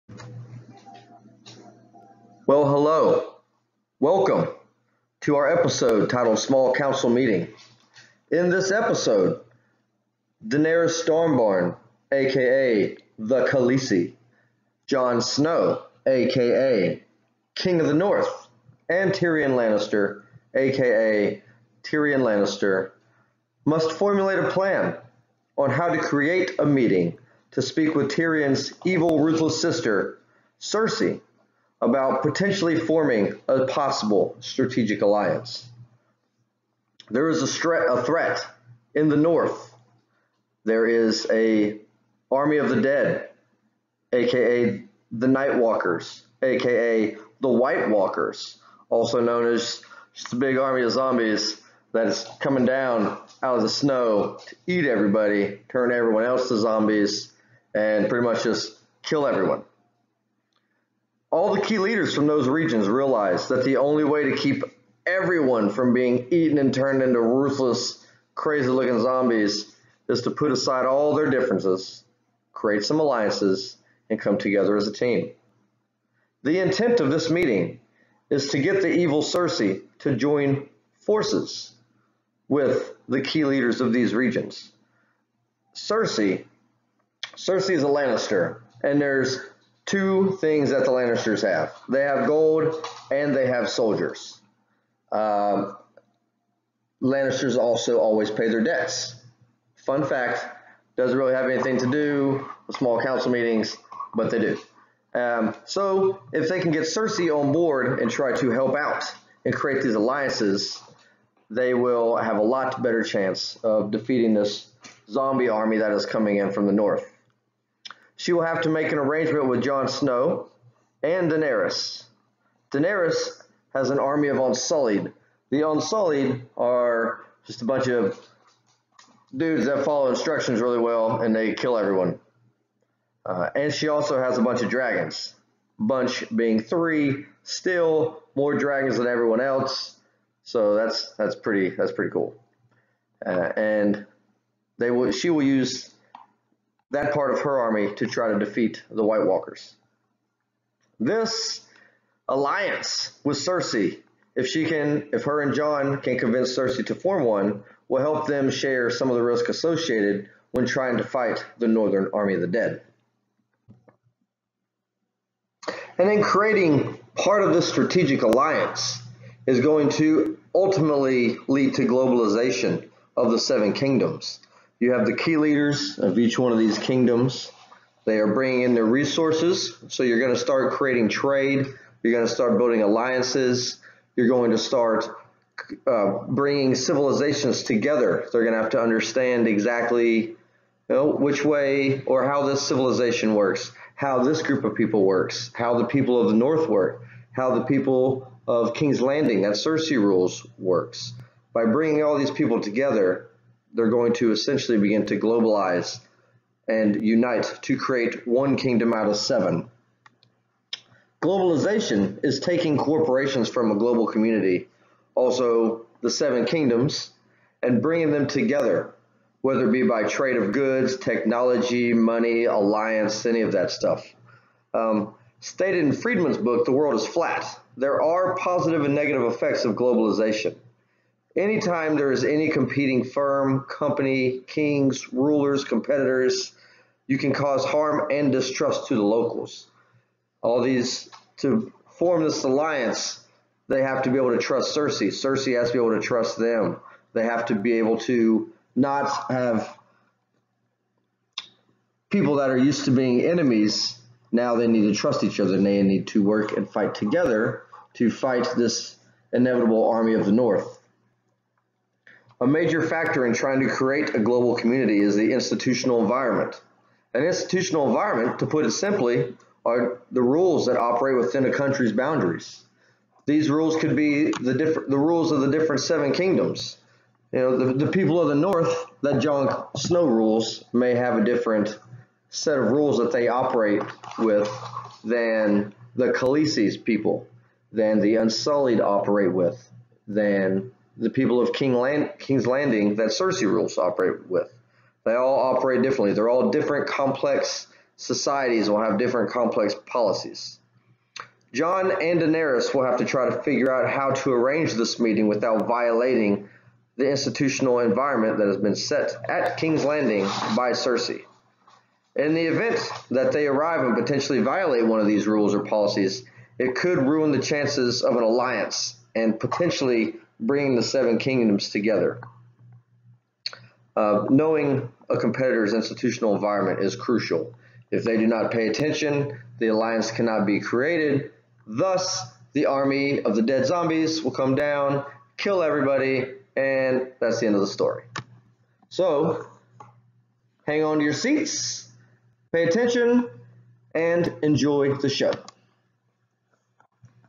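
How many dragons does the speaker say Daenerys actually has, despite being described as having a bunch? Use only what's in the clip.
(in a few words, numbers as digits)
3.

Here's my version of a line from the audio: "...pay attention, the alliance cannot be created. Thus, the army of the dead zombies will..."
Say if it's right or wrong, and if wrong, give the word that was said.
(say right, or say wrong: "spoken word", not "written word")
right.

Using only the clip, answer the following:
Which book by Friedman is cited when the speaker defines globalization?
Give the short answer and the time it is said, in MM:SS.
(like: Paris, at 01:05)
The World is Flat, at 03:46.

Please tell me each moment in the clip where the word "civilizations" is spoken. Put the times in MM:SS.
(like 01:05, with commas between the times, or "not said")
03:06, 03:12.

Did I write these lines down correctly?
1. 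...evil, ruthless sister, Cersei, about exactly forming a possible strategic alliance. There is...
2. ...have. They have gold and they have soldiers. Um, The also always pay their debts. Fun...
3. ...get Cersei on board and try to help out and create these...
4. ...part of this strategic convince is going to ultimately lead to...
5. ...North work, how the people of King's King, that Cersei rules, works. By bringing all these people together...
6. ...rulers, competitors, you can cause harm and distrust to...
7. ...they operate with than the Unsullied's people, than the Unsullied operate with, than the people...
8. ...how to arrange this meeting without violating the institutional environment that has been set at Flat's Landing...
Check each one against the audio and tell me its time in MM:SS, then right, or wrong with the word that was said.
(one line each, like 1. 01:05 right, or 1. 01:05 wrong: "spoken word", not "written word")
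1. 00:28 wrong: "potentially", not "exactly"
2. 01:31 wrong: "Lannisters", not "The"
3. 01:46 right
4. 02:47 wrong: "alliance", not "convince"
5. 03:16 wrong: "Landing", not "King"
6. 03:55 right
7. 04:43 wrong: "Khaleesi", not "Unsullied"
8. 05:03 wrong: "King", not "Flat".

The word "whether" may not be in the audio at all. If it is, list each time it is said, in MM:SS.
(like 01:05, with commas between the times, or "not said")
03:39.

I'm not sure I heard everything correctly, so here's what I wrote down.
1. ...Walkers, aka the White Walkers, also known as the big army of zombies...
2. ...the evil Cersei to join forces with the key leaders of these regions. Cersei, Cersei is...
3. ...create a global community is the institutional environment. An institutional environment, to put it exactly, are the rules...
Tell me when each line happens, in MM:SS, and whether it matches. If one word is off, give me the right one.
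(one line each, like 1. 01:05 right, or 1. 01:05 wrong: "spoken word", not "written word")
1. 00:45 right
2. 01:18 right
3. 04:23 wrong: "simply", not "exactly".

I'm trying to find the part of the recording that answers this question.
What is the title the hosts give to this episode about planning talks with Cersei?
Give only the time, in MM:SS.
00:06.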